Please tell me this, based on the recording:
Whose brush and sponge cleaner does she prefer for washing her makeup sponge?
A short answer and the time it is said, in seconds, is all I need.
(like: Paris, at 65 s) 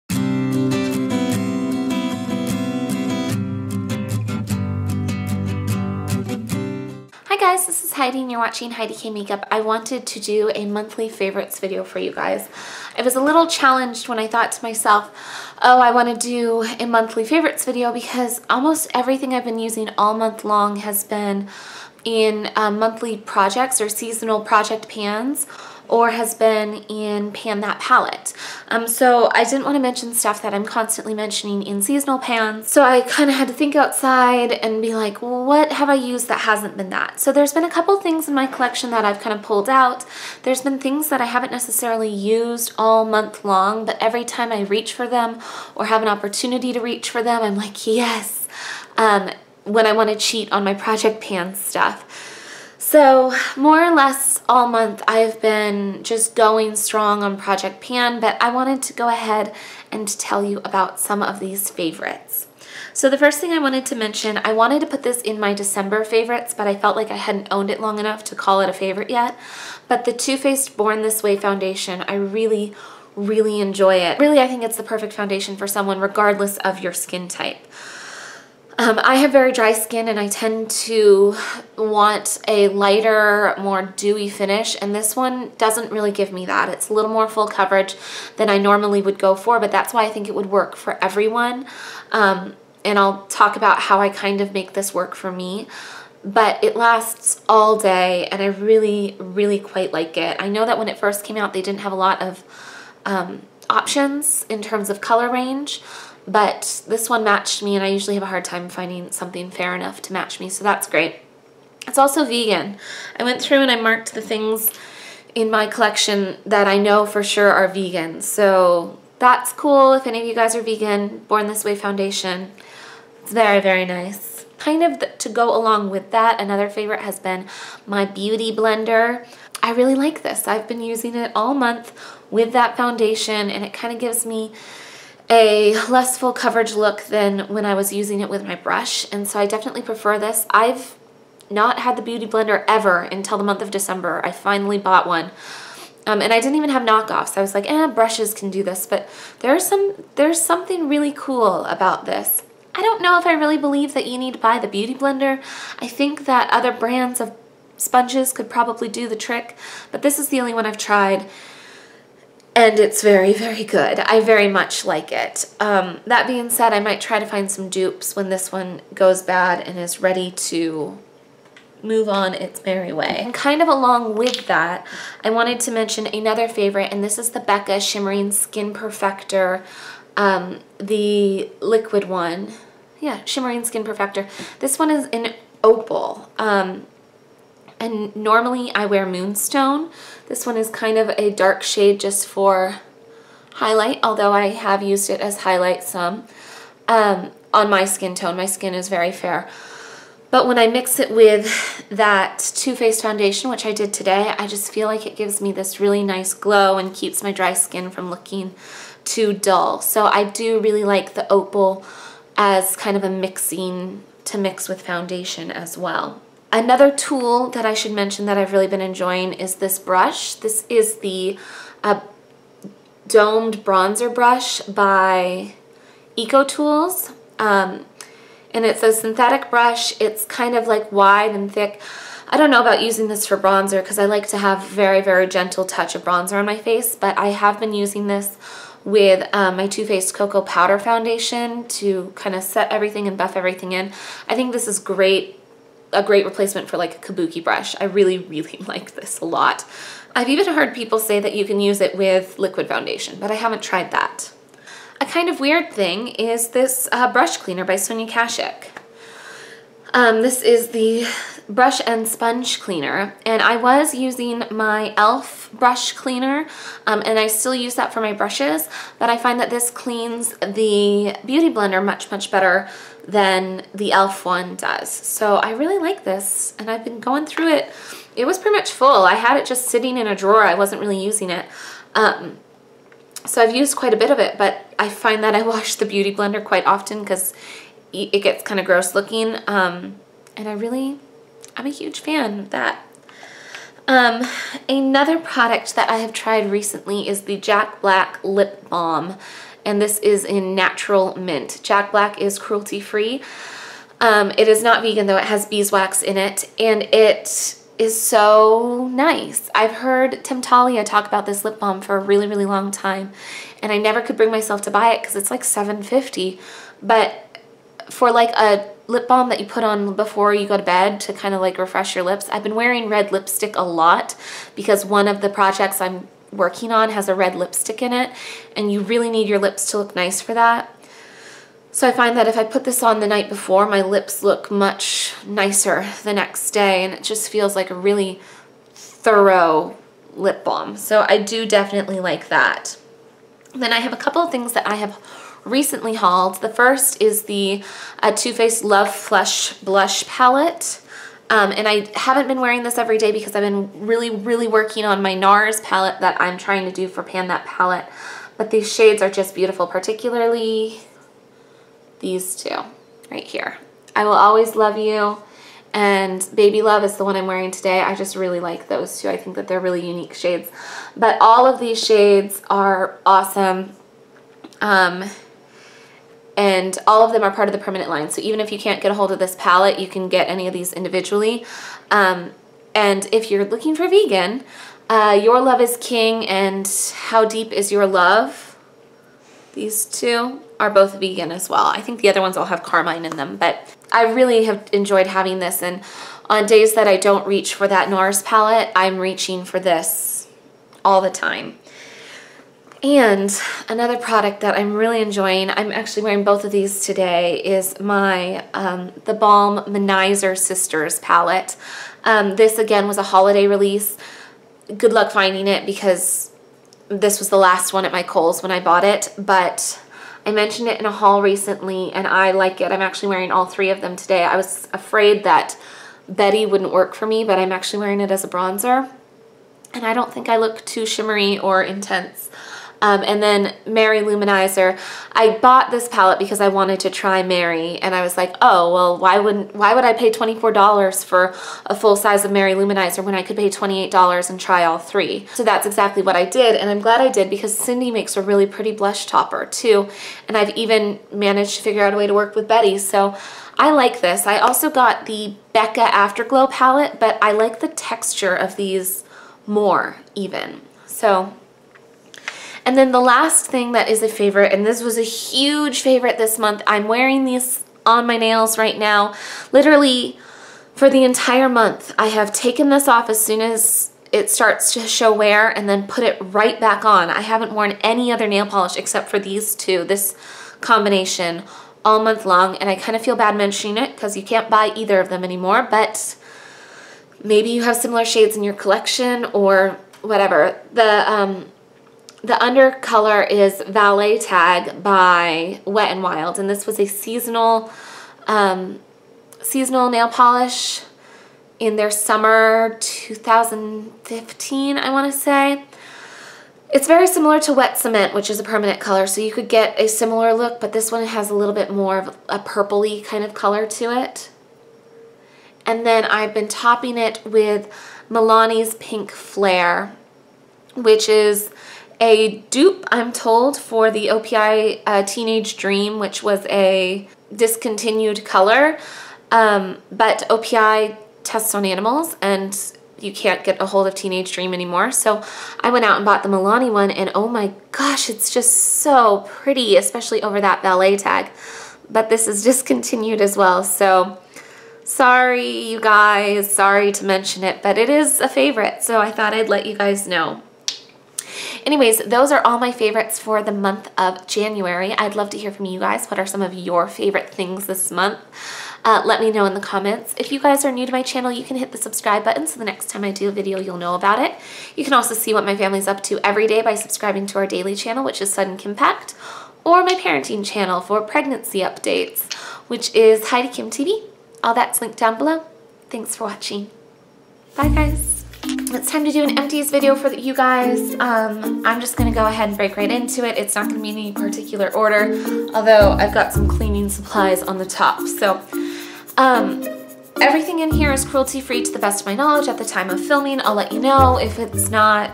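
Sonia Kashuk, at 257 s.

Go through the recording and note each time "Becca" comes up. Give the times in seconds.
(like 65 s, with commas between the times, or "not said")
177 s, 455 s.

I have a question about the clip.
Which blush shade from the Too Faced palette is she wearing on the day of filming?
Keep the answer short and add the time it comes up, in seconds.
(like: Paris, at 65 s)
Baby Love, at 366 s.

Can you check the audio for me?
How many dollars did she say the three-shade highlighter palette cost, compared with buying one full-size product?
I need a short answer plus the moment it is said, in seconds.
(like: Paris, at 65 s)
28, at 443 s.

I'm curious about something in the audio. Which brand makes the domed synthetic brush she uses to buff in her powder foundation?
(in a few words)
EcoTools.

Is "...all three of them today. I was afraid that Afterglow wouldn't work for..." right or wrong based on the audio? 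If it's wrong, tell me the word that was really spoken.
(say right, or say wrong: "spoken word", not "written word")
wrong: "Betty", not "Afterglow".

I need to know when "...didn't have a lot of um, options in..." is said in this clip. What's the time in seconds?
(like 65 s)
101 s.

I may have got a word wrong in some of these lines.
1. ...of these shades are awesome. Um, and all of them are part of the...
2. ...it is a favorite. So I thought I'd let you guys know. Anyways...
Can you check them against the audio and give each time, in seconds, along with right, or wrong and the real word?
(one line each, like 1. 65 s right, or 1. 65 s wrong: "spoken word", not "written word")
1. 371 s right
2. 547 s right.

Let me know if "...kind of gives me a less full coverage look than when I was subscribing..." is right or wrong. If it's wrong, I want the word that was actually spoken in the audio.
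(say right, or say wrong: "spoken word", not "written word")
wrong: "using", not "subscribing".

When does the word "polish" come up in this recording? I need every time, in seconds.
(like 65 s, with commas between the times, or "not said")
478 s, 500 s.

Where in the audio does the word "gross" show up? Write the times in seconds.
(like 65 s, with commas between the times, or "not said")
288 s.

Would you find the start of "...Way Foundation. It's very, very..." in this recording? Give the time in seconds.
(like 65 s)
121 s.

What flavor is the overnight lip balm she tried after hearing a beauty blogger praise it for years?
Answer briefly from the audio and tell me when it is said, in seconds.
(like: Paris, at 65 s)
Natural mint, at 300 s.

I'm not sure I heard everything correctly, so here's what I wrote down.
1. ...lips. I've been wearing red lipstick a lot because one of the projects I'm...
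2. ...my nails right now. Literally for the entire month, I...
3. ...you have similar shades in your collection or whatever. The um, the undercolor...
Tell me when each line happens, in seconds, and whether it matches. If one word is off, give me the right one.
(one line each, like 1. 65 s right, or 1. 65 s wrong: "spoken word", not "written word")
1. 322 s right
2. 468 s right
3. 487 s right.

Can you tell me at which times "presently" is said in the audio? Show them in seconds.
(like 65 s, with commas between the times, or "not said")
not said.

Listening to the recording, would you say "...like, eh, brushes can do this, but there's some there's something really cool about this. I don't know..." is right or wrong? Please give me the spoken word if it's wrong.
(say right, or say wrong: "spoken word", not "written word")
right.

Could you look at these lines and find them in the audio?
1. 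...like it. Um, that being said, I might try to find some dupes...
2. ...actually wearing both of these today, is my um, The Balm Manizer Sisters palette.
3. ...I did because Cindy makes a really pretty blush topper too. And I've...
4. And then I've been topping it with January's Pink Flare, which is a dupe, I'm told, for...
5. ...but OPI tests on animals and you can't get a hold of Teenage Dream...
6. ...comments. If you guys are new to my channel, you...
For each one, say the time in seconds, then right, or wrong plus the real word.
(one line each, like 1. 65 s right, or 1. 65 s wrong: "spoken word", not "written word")
1. 164 s right
2. 405 s right
3. 447 s right
4. 515 s wrong: "Milani", not "January"
5. 529 s right
6. 559 s right.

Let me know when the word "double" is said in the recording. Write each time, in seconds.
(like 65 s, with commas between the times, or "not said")
not said.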